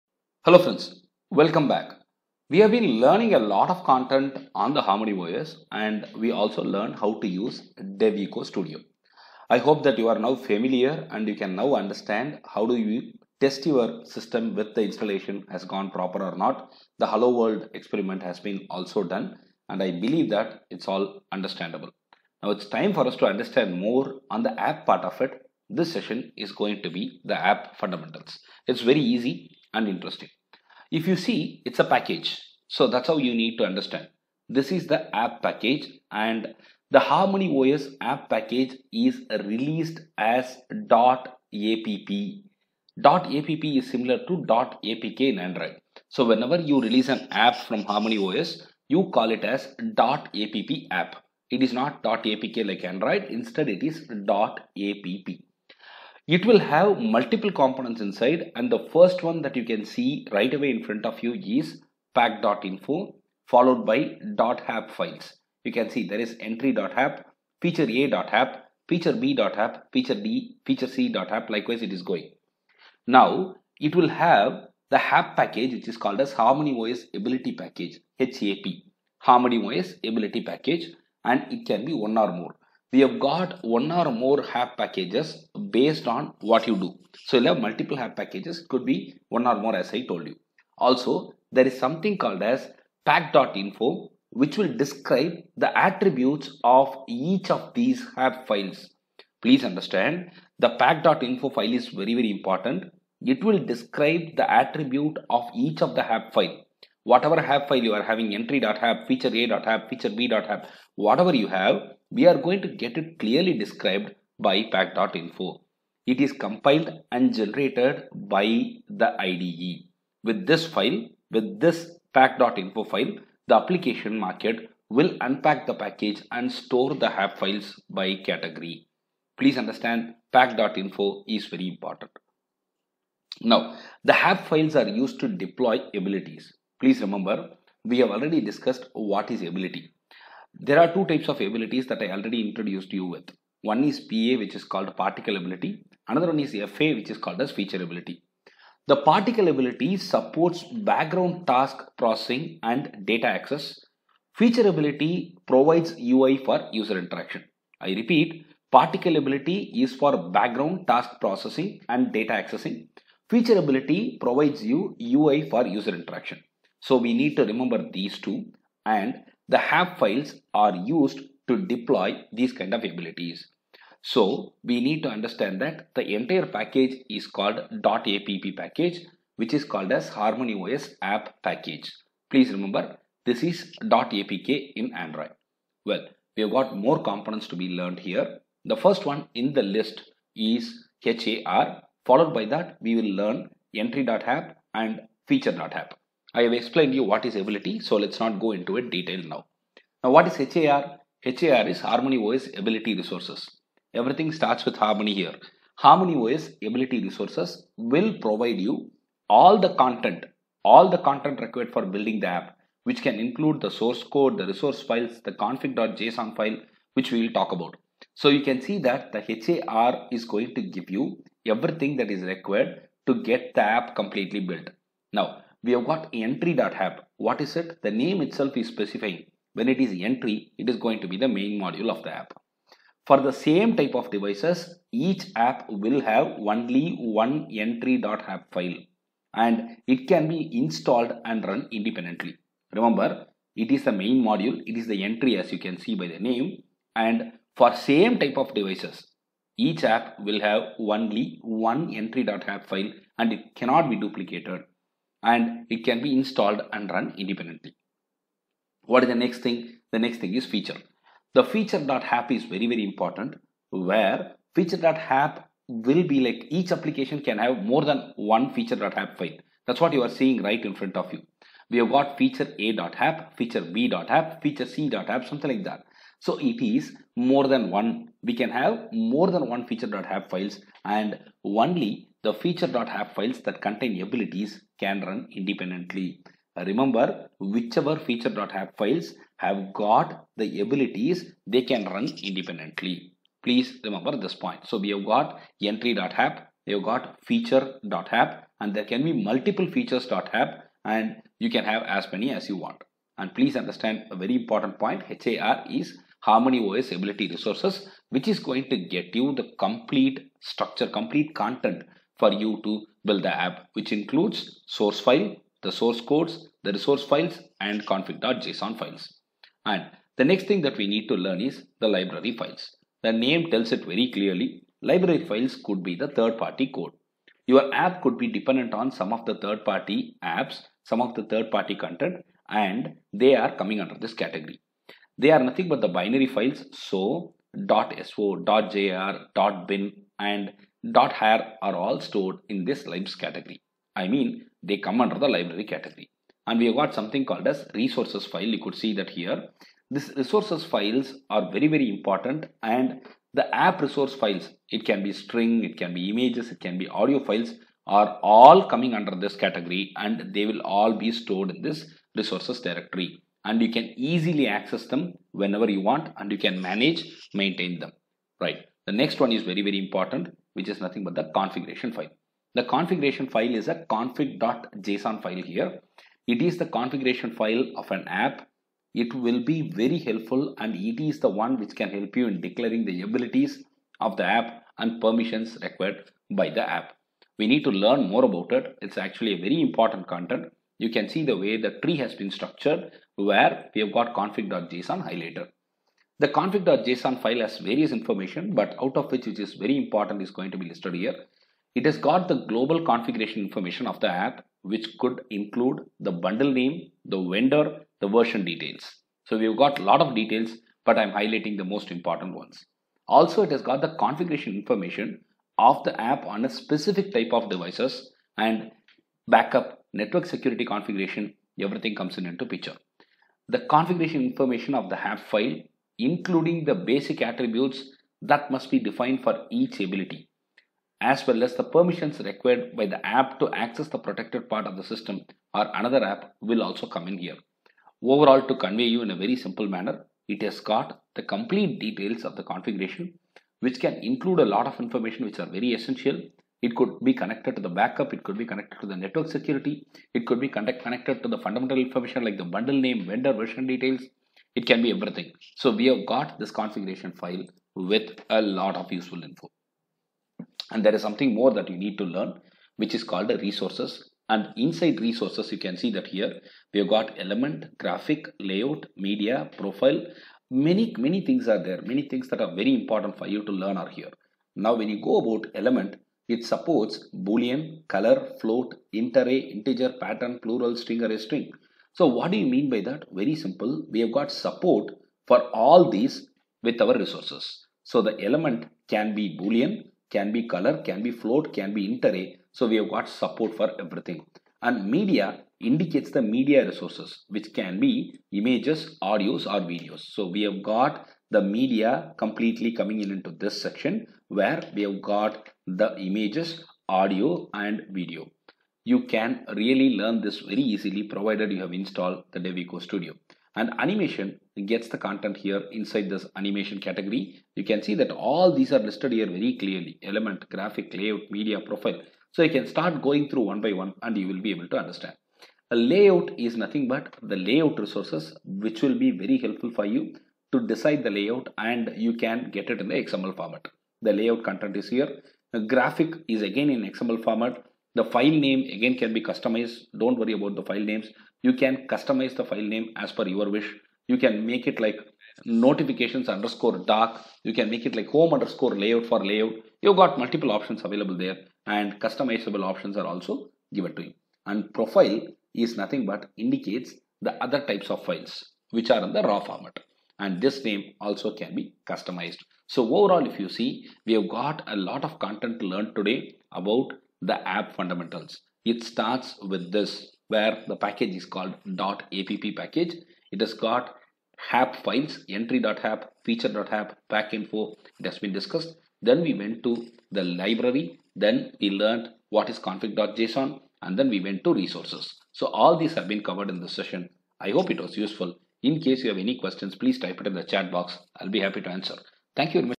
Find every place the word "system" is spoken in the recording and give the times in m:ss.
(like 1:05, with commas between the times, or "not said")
0:14, 7:14.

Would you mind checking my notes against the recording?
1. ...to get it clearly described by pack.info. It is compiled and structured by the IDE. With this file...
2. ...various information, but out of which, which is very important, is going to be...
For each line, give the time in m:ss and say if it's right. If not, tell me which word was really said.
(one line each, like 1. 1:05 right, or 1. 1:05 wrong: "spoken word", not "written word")
1. 1:52 wrong: "generated", not "structured"
2. 6:37 right.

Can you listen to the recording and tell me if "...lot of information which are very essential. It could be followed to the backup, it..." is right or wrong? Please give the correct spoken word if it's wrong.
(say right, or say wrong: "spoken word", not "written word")
wrong: "connected", not "followed".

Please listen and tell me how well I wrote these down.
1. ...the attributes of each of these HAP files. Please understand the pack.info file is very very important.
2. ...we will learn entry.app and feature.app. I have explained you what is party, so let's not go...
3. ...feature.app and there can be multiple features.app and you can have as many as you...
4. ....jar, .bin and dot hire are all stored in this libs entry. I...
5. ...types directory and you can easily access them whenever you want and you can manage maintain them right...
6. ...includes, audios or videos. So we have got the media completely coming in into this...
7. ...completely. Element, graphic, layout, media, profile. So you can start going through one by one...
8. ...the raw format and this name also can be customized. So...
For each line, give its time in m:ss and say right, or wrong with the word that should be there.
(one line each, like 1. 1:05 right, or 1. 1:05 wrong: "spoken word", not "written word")
1. 1:35 right
2. 3:12 wrong: "ability", not "party"
3. 4:57 right
4. 5:38 wrong: "category", not "entry"
5. 6:02 wrong: "resources", not "types"
6. 8:18 wrong: "images", not "includes"
7. 8:39 wrong: "clearly", not "completely"
8. 9:19 right.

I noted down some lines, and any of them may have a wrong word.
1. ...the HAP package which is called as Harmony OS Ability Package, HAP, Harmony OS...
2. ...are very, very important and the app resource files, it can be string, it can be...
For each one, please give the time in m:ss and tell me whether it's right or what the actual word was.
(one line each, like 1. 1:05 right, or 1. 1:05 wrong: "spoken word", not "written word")
1. 1:14 right
2. 5:51 right.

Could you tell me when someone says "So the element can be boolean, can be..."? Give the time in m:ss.
8:07.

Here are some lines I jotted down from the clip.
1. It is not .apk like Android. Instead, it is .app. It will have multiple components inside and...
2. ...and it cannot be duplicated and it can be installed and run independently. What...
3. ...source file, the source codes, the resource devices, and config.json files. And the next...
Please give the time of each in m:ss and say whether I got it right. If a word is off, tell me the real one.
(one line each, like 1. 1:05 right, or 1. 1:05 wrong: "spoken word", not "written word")
1. 0:51 right
2. 4:13 right
3. 5:14 wrong: "files", not "devices".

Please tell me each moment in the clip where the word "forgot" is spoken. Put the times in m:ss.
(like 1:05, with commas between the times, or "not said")
not said.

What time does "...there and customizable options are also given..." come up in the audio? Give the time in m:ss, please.
9:11.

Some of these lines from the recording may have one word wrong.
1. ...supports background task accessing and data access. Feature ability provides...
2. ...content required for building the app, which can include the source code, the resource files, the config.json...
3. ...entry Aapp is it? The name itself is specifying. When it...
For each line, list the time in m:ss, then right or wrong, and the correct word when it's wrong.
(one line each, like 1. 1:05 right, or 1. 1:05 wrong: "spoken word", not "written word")
1. 2:29 wrong: "processing", not "accessing"
2. 3:30 right
3. 3:46 wrong: "What", not "Aapp".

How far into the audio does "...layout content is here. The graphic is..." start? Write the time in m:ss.
8:54.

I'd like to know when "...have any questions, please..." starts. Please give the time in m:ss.
9:49.